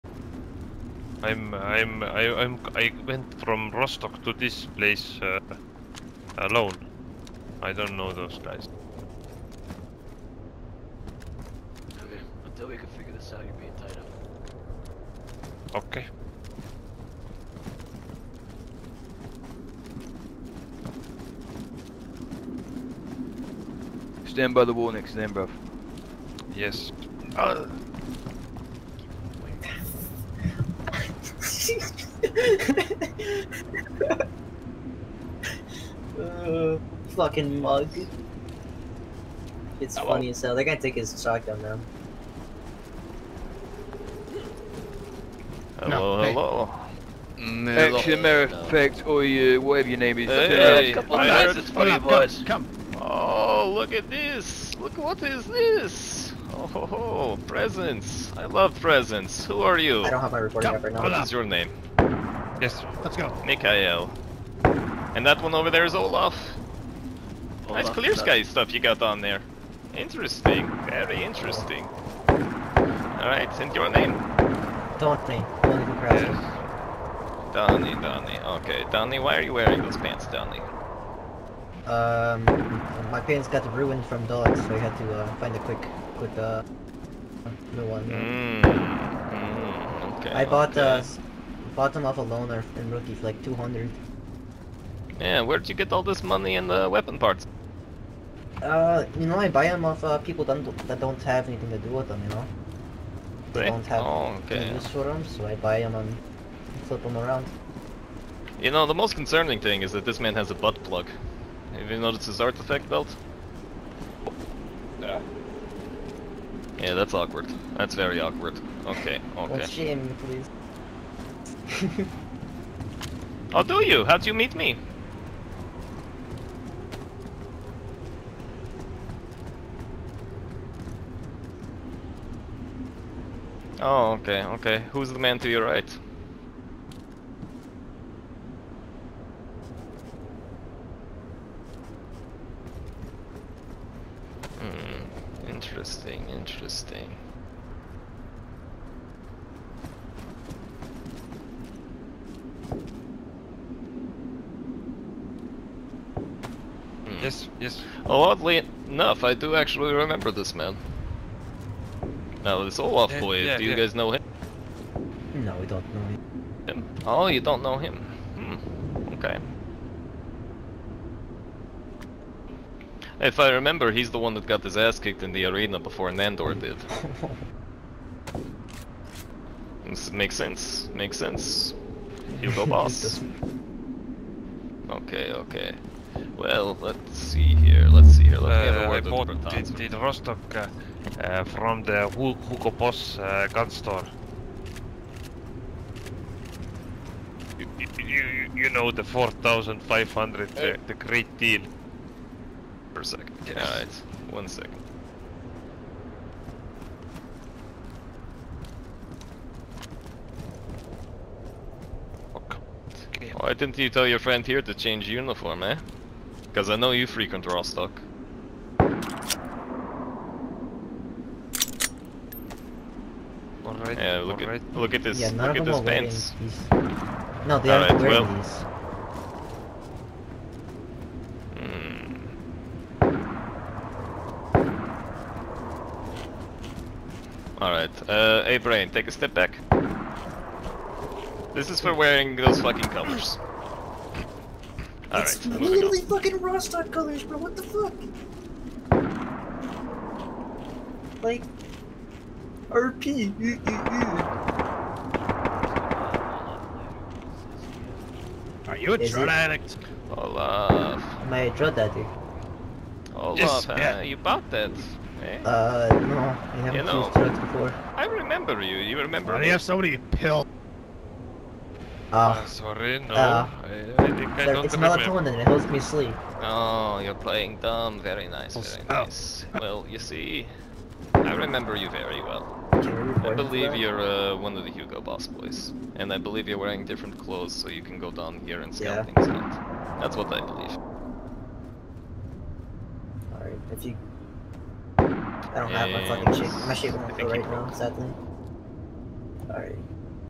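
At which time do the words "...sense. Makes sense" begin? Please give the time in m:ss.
3:00.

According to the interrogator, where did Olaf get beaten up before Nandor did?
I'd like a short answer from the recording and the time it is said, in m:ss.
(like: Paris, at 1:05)
The arena, at 2:55.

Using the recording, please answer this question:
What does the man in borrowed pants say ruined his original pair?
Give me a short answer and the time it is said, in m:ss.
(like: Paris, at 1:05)
Dogs, at 1:24.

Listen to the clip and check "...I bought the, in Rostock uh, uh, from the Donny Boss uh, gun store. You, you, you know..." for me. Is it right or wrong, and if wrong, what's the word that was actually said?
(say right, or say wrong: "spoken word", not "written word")
wrong: "Hugo", not "Donny".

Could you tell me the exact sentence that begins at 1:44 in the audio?
use for them, so I buy them and flip them around.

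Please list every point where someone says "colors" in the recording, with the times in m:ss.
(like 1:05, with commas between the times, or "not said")
4:02, 4:06.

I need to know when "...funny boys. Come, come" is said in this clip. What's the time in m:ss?
0:51.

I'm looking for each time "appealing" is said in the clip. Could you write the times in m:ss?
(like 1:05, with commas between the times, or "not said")
not said.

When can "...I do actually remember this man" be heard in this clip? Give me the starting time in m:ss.
2:39.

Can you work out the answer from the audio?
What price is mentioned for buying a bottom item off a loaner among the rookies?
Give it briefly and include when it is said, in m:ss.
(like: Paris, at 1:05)
200, at 1:33.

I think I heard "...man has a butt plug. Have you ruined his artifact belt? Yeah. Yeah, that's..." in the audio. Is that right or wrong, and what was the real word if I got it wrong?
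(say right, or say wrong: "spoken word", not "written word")
wrong: "noticed", not "ruined".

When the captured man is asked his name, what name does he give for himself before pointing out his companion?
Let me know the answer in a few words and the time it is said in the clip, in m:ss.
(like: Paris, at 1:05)
Mikael, at 1:03.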